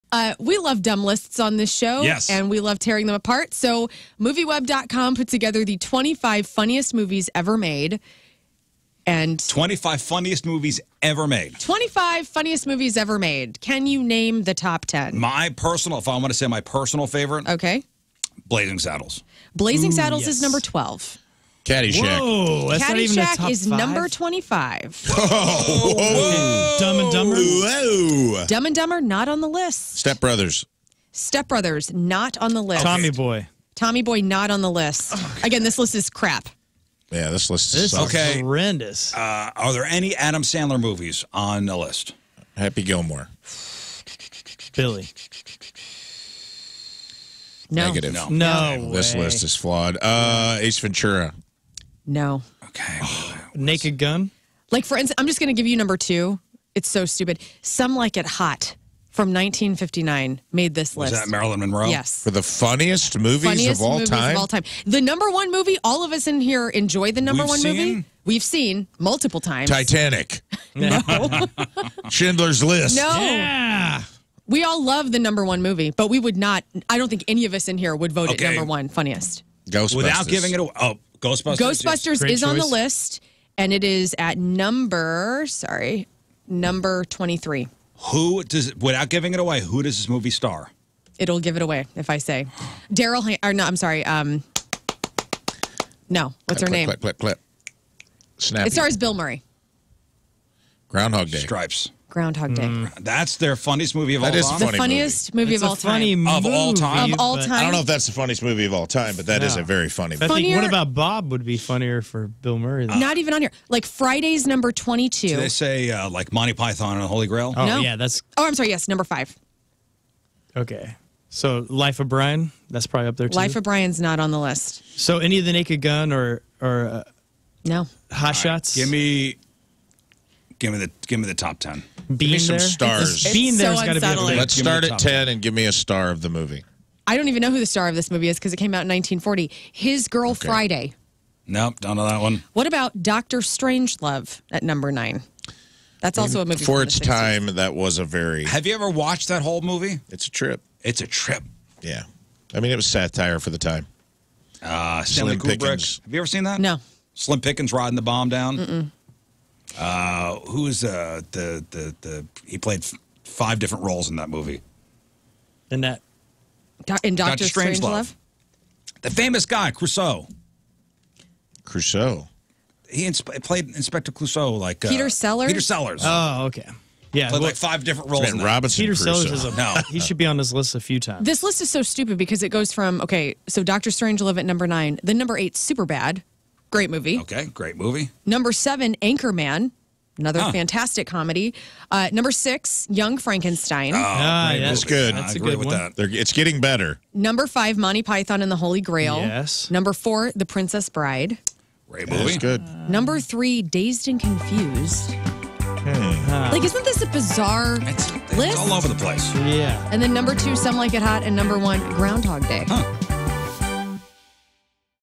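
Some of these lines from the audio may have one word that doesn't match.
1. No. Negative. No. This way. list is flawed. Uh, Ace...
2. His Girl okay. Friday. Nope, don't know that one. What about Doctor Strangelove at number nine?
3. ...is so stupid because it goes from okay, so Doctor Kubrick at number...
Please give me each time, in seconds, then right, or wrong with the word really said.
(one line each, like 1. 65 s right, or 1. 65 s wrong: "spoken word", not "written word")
1. 47 s right
2. 139 s right
3. 181 s wrong: "Strangelove", not "Kubrick".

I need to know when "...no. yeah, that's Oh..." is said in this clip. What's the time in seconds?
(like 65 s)
117 s.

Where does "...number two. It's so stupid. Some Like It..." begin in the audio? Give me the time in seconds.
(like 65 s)
55 s.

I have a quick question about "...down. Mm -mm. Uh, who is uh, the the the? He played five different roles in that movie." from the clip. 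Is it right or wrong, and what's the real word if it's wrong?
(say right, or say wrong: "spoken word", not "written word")
right.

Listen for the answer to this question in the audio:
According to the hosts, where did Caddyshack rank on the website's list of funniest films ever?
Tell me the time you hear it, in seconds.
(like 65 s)
23 s.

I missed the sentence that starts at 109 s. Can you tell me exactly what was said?
a very funny I think what about Bob would be funnier for Bill Murray.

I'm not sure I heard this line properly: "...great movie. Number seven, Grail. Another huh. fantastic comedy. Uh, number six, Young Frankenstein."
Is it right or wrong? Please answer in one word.
wrong.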